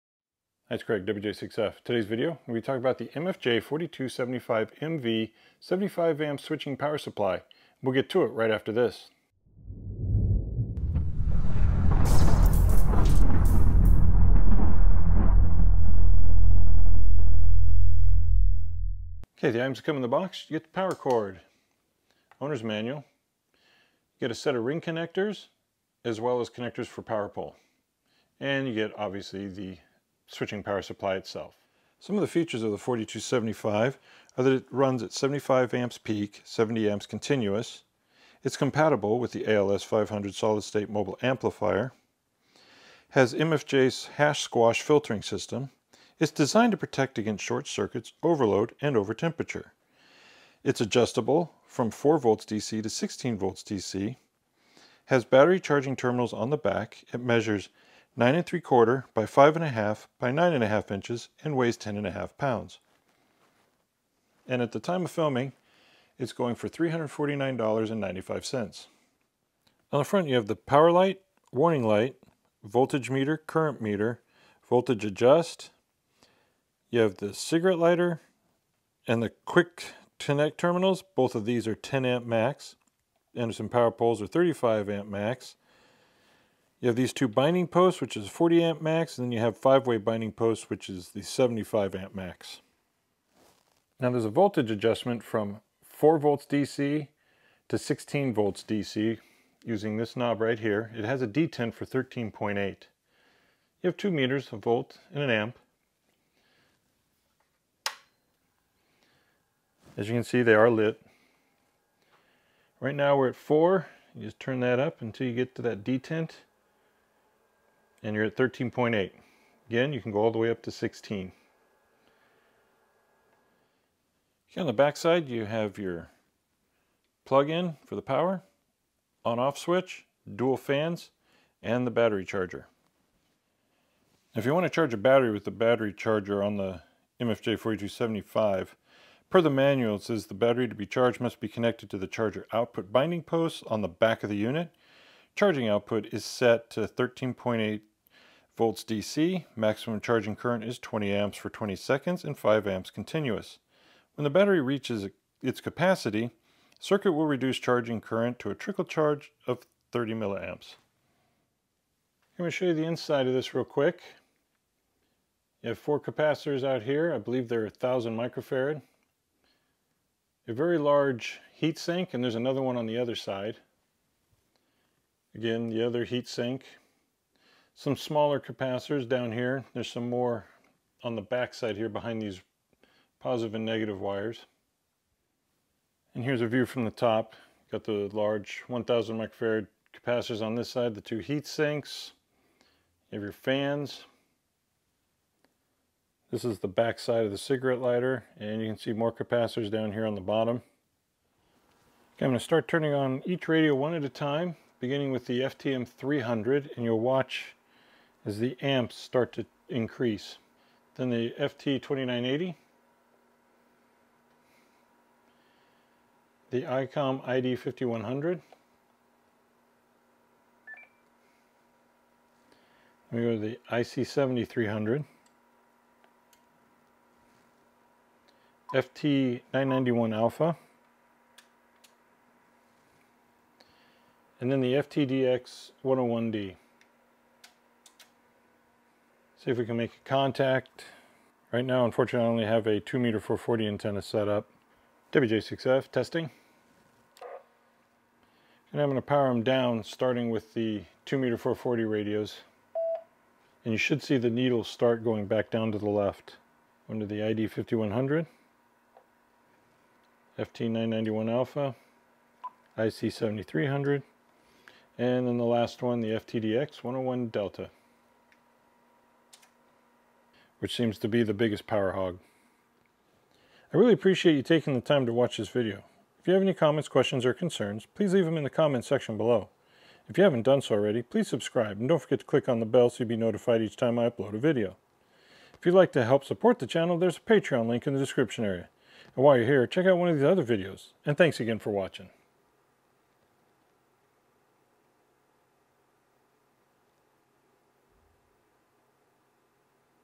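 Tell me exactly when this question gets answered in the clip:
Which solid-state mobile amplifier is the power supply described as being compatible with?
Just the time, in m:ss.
0:39.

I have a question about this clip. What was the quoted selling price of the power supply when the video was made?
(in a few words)
$349.95.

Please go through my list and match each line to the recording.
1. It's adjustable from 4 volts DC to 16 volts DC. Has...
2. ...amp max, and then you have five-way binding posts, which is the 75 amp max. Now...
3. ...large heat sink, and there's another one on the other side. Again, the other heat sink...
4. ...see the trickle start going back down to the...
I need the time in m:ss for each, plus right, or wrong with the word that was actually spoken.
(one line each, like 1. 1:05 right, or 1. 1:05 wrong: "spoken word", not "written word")
1. 0:50 right
2. 1:28 right
3. 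2:50 right
4. 4:14 wrong: "needle", not "trickle".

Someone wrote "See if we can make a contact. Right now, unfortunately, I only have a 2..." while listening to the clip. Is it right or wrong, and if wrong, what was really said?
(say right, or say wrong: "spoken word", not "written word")
right.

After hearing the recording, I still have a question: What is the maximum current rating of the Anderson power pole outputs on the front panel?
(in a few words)
35 amps.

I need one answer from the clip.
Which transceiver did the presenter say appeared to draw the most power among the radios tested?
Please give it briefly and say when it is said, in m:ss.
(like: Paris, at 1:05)
FTDX 101 Delta, at 4:26.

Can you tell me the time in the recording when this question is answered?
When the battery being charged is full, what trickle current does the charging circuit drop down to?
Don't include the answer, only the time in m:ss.
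2:39.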